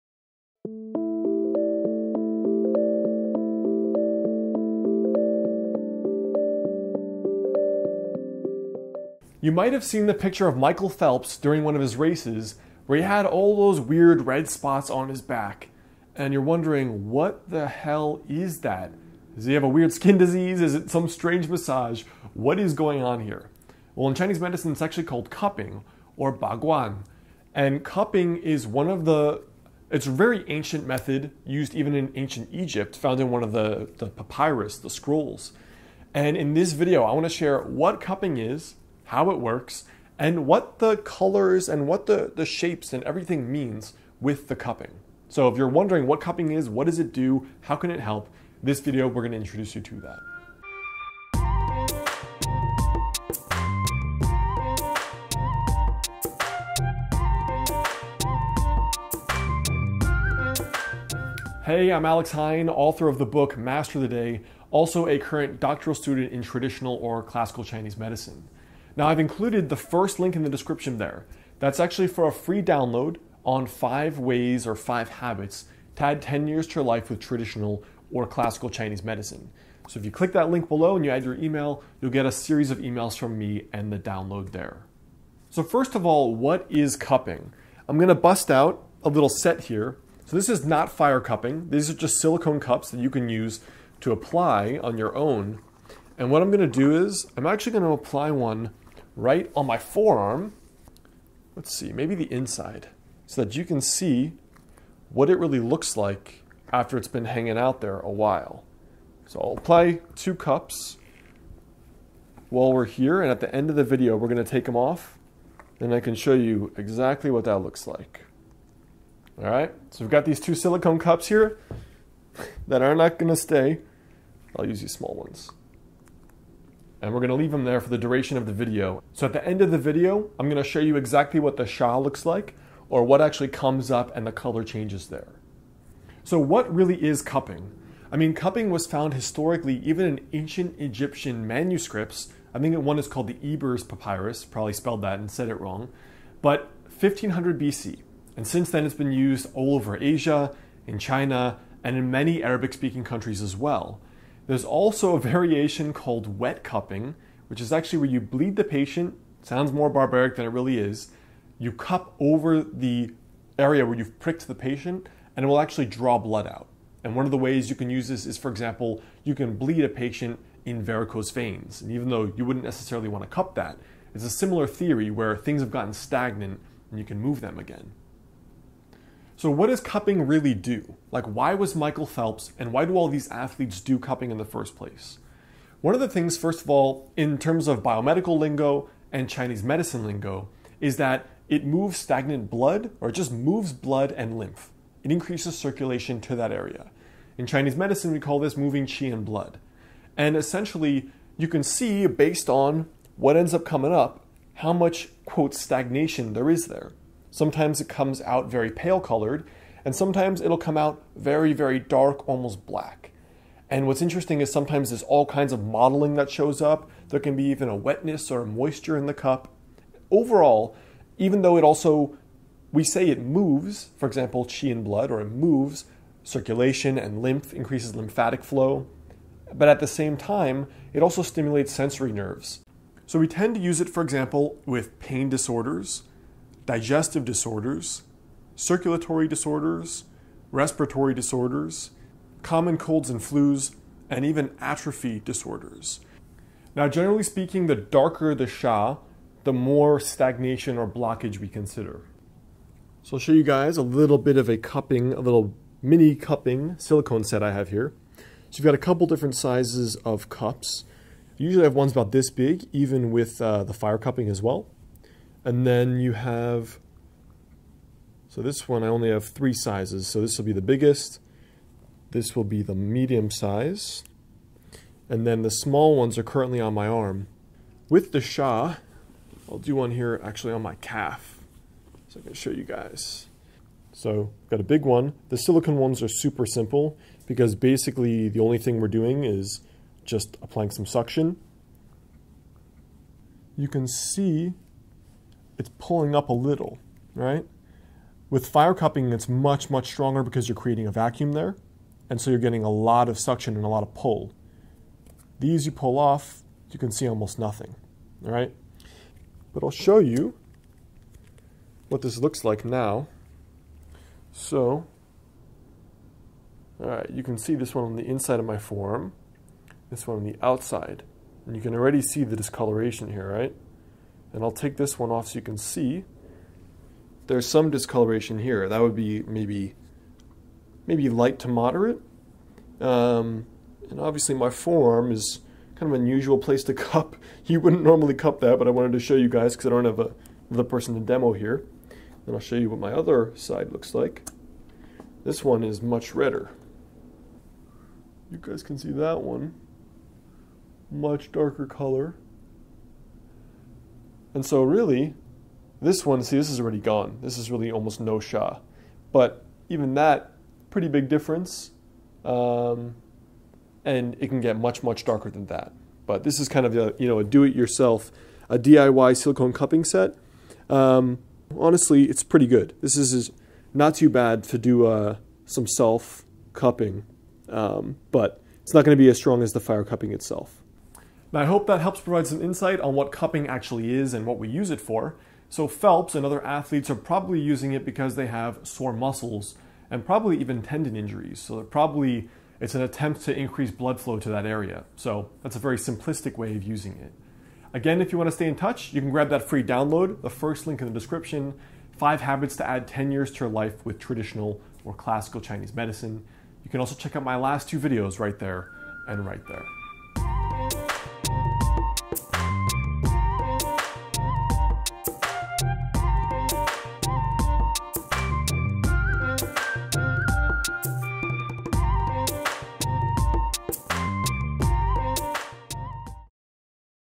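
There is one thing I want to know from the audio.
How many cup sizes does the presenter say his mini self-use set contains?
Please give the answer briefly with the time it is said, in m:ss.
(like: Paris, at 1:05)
3, at 4:29.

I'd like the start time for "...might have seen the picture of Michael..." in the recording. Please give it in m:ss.
0:09.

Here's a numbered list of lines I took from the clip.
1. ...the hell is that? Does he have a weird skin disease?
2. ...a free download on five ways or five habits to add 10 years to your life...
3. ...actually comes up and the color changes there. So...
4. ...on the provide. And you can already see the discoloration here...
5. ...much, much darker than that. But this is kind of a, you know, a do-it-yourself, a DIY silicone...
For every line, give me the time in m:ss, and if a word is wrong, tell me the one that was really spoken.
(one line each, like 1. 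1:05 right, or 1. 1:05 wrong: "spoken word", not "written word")
1. 0:17 right
2. 1:12 right
3. 2:13 right
4. 5:20 wrong: "outside", not "provide"
5. 6:04 right.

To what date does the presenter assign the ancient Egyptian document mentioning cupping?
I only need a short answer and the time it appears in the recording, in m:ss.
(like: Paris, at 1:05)
1500 BC, at 2:26.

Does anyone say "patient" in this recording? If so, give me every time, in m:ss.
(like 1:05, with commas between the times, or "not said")
2:38, 2:44, 2:49.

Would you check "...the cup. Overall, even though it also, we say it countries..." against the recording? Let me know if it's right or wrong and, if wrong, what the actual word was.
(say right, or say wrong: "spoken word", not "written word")
wrong: "moves", not "countries".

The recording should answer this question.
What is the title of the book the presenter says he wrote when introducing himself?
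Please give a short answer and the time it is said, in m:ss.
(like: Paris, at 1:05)
Master the Day, at 1:03.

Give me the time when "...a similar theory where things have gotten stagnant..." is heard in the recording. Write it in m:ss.
2:54.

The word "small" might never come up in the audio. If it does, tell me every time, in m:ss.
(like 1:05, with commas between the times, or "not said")
2:04, 4:35.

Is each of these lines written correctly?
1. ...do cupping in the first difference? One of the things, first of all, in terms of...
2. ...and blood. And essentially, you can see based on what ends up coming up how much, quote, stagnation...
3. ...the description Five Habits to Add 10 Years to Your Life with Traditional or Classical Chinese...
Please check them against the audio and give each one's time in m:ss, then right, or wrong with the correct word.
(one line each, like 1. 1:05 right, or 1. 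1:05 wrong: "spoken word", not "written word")
1. 3:03 wrong: "place", not "difference"
2. 3:19 right
3. 6:40 right.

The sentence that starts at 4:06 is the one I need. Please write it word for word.
Now, generally speaking, the darker the Sha, the more stagnation or blockage we consider.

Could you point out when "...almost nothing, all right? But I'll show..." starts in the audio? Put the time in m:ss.
5:07.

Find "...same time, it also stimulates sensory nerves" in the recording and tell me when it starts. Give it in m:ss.
3:49.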